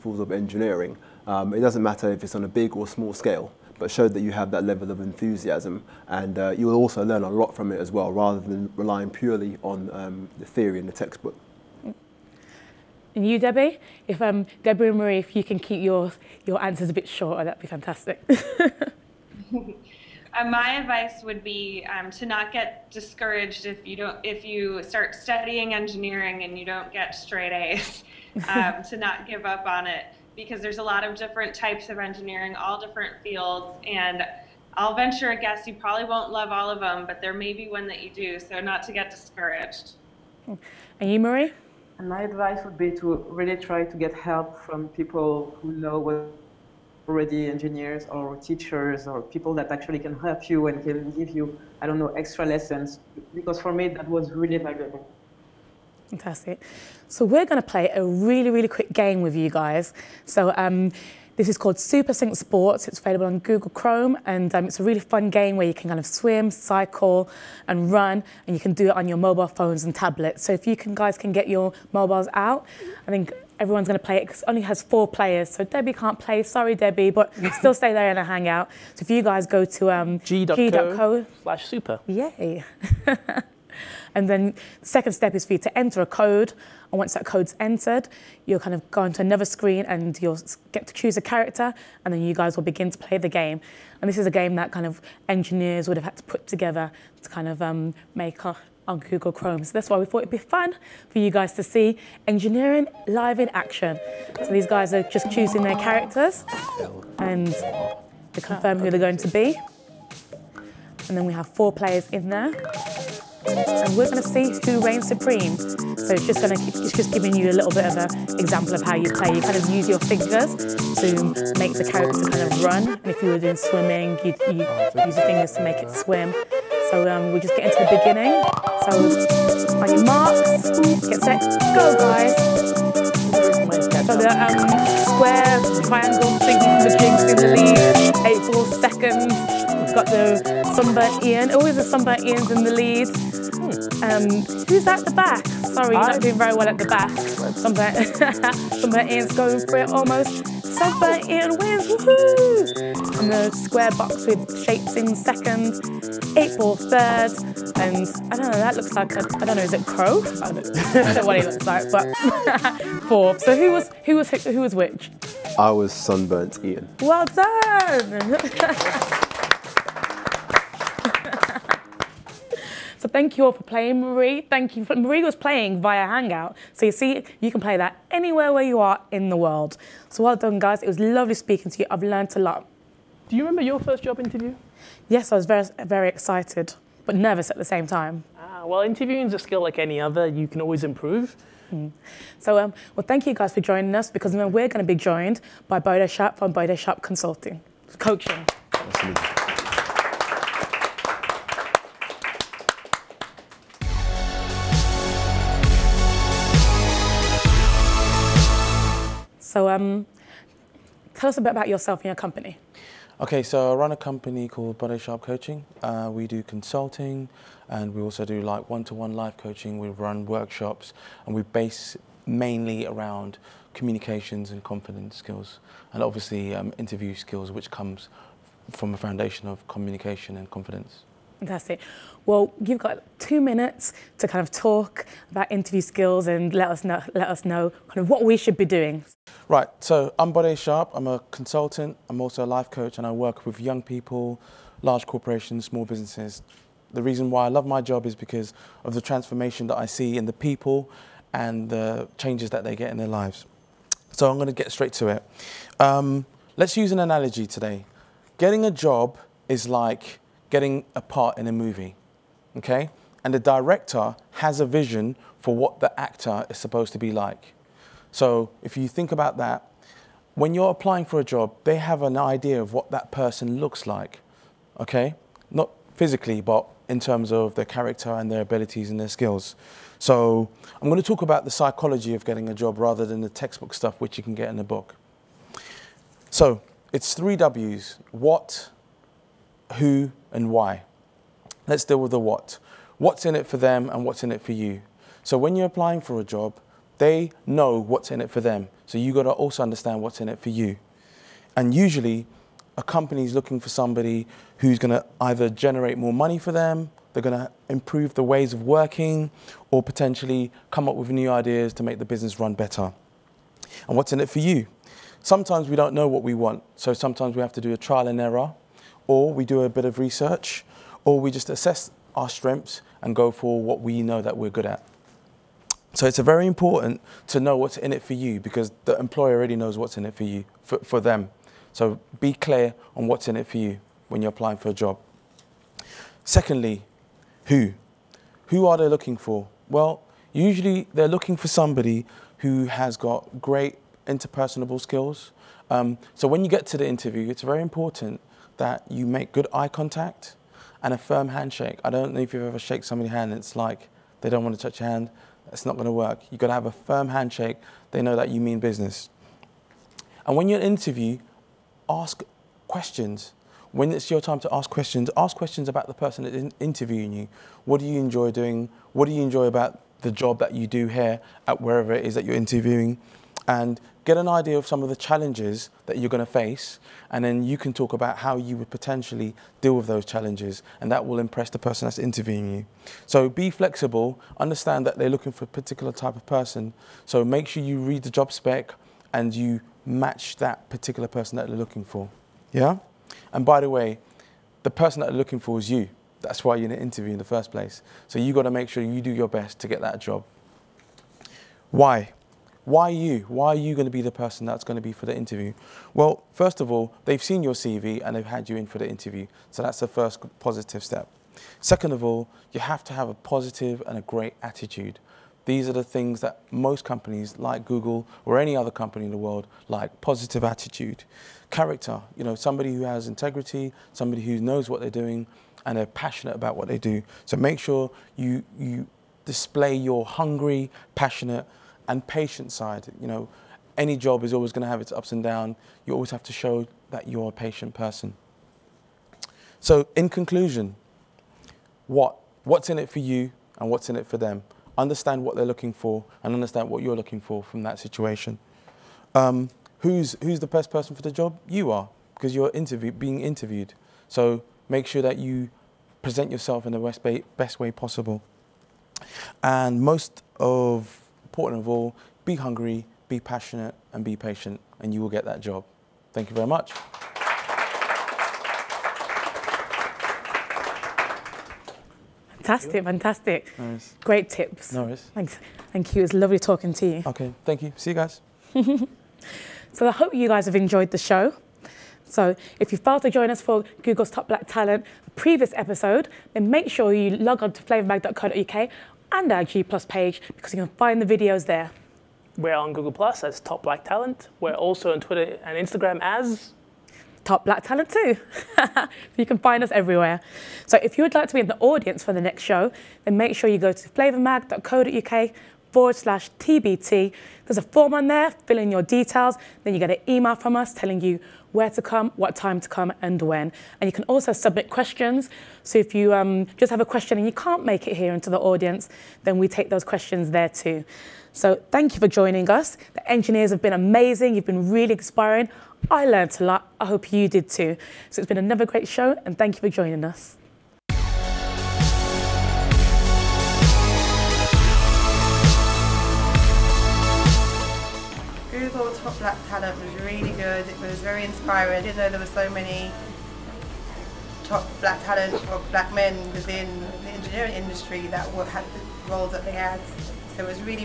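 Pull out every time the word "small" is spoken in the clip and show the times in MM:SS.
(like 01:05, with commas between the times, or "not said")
00:02, 04:05.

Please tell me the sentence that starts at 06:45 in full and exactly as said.
Well, first of all, they've seen your CV and they've had you in for the interview.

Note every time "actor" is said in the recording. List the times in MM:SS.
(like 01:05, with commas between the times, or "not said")
04:25.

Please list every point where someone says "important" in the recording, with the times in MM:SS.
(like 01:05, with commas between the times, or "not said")
05:26, 05:47, 07:41.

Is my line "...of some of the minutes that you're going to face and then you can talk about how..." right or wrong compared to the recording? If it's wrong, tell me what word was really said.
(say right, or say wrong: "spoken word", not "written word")
wrong: "challenges", not "minutes".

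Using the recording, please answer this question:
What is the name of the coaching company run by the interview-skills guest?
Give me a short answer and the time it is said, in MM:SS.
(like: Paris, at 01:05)
Bode Sharp Coaching, at 03:34.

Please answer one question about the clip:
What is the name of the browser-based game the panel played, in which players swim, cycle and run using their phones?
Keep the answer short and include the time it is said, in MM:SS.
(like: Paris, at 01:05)
SuperSync Sports, at 01:01.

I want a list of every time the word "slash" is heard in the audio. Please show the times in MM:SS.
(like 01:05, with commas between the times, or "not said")
01:21, 08:25.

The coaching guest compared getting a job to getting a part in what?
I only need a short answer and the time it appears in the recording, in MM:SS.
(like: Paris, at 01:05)
A movie, at 04:20.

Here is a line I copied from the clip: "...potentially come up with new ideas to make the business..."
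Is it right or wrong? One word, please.
right.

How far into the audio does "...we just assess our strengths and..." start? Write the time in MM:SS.
05:21.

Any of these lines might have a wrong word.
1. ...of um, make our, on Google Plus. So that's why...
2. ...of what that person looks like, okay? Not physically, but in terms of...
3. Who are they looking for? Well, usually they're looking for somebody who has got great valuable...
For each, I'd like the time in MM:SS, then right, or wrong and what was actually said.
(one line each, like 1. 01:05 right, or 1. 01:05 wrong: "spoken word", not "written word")
1. 01:37 wrong: "Chrome", not "Plus"
2. 04:32 right
3. 05:38 wrong: "interpersonable", not "valuable".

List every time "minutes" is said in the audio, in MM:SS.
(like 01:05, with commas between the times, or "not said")
03:53.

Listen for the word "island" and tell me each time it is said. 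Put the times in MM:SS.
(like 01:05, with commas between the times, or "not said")
not said.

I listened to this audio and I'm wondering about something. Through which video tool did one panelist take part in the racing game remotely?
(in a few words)
Hangout.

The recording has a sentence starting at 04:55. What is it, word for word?
So when you're applying for a job, they know what's in it for them.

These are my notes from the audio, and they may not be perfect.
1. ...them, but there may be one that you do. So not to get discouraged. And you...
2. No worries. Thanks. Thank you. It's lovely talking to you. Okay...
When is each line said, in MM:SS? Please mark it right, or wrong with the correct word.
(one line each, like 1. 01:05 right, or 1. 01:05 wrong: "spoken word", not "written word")
1. 00:36 right
2. 07:54 right.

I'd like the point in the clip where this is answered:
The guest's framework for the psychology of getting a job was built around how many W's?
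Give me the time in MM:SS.
04:47.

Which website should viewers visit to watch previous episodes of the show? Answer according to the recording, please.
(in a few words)
flavormag.co.uk.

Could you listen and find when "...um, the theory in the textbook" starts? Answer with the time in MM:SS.
00:09.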